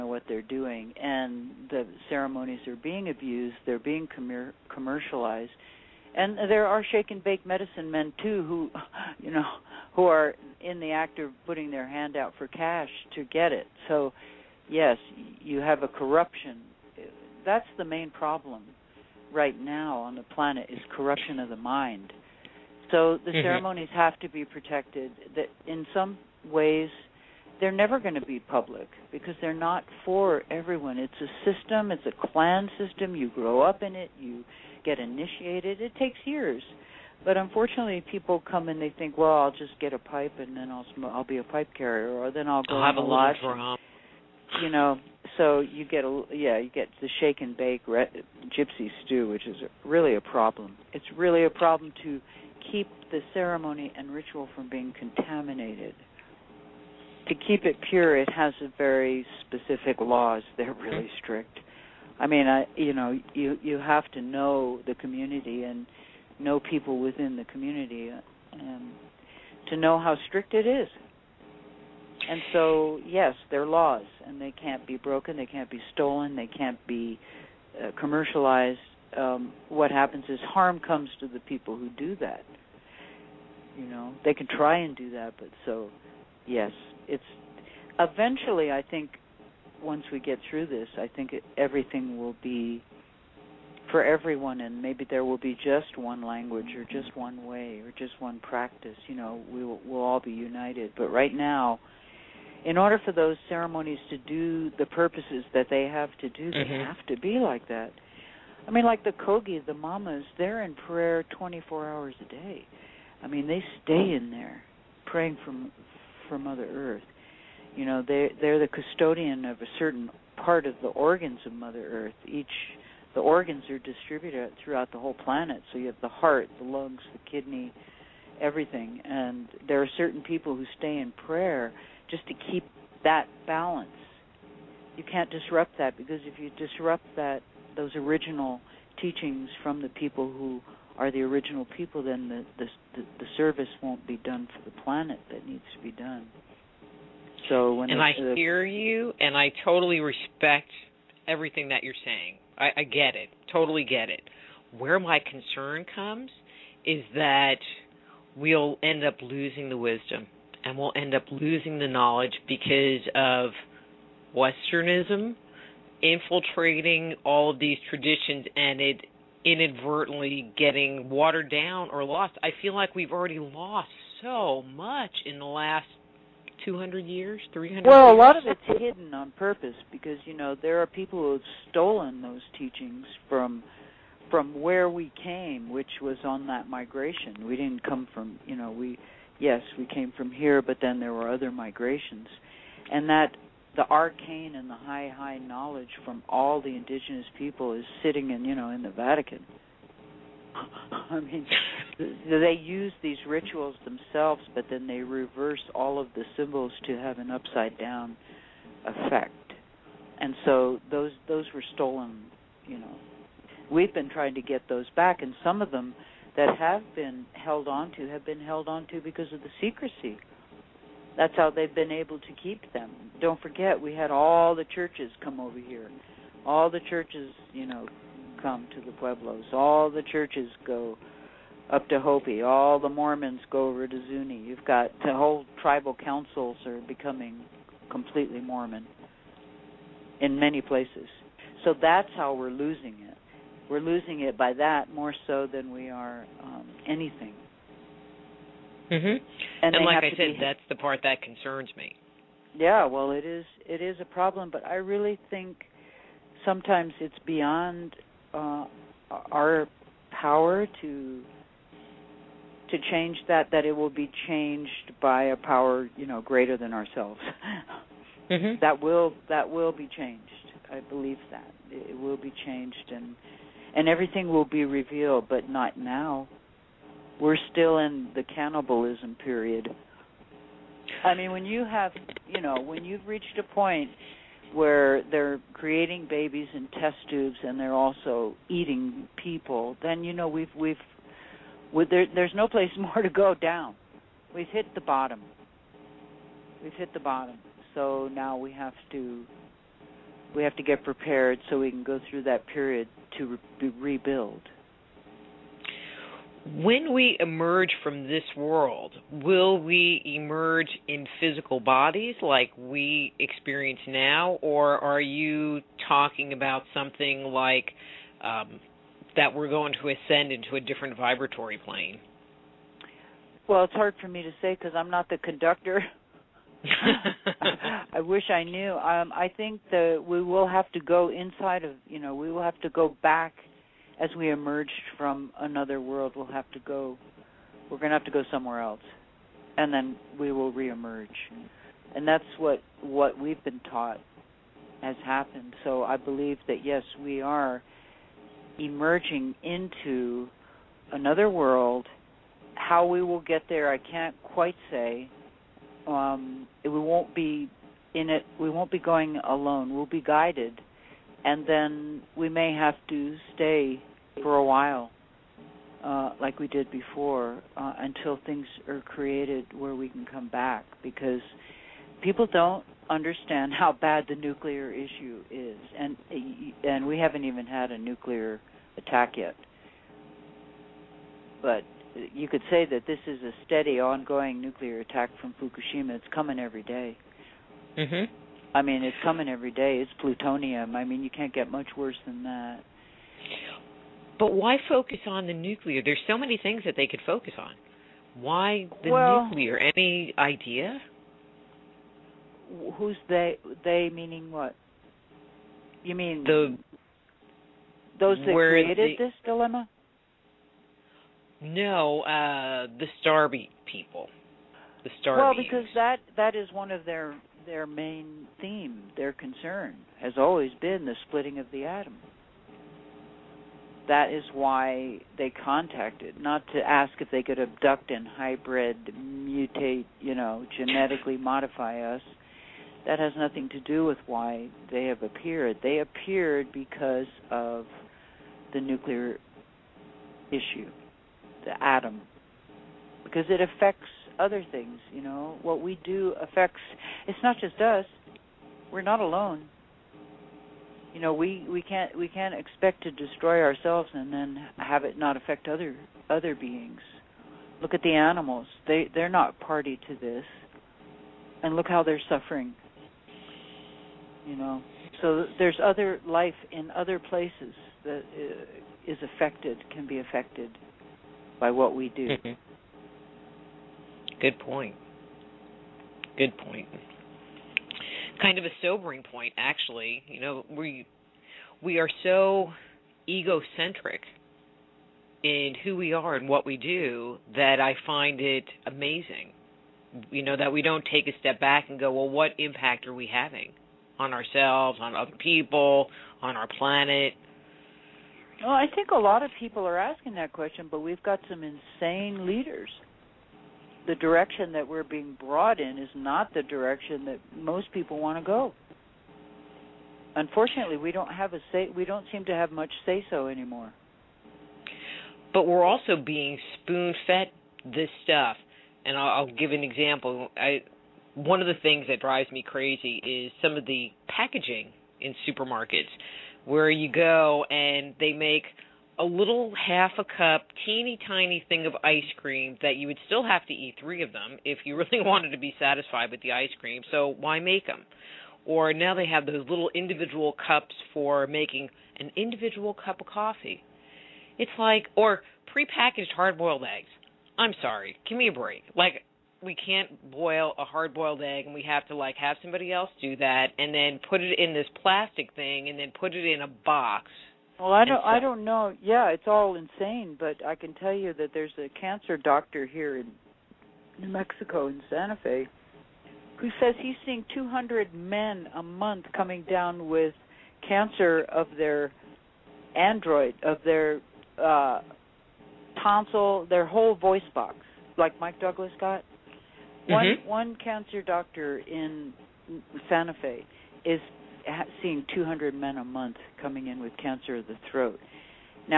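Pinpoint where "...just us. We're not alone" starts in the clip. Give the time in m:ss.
7:27.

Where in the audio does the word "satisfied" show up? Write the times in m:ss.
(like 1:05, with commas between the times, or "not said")
8:55.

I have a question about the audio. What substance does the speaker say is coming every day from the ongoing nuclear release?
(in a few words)
Plutonium.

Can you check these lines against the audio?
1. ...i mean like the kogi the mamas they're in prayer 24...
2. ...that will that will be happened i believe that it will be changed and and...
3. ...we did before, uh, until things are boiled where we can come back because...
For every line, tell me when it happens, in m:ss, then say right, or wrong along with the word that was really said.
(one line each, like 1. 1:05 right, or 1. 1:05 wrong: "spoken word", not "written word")
1. 1:48 right
2. 4:28 wrong: "changed", not "happened"
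3. 6:06 wrong: "created", not "boiled".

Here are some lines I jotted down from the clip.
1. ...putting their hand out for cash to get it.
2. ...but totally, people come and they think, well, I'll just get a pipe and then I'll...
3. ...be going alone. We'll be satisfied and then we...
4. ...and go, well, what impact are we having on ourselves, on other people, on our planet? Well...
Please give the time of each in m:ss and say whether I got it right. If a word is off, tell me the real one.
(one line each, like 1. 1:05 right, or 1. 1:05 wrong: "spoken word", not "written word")
1. 0:11 right
2. 0:37 wrong: "unfortunately", not "totally"
3. 5:58 wrong: "guided", not "satisfied"
4. 8:11 right.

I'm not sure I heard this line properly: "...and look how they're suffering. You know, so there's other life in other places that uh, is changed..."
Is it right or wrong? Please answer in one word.
wrong.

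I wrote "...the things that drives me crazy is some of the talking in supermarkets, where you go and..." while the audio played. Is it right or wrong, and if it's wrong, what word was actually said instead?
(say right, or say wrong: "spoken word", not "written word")
wrong: "packaging", not "talking".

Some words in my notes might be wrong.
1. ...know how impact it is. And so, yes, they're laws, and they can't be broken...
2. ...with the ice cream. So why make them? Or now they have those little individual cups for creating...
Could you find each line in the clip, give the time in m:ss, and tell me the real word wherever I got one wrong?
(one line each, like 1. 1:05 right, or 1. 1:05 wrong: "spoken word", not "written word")
1. 1:09 wrong: "strict", not "impact"
2. 8:56 wrong: "making", not "creating".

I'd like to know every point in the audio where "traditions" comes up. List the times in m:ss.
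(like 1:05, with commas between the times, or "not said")
2:47.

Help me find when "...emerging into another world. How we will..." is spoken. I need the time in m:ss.
5:48.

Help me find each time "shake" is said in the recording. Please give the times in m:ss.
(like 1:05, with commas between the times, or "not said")
0:06, 0:47.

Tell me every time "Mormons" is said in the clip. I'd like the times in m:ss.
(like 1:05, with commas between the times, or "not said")
3:52, 3:58.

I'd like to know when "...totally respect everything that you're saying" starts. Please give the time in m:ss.
2:29.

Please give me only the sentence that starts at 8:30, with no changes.
Unfortunately, we don't have a say.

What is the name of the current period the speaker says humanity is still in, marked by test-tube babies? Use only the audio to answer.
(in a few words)
cannibalism period.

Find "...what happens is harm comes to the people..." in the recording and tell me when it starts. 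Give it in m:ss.
1:19.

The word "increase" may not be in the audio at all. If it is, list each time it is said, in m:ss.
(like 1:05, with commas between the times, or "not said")
not said.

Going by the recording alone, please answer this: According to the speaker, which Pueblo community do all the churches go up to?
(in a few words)
Hopi.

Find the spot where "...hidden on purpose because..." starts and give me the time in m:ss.
2:58.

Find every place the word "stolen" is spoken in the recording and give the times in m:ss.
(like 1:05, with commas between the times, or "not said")
1:15, 3:01, 3:31.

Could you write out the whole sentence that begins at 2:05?
So you have the heart, the lungs, the kidney, everything.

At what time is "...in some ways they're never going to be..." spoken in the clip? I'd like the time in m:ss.
0:25.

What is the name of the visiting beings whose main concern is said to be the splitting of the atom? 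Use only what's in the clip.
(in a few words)
Starbeat people.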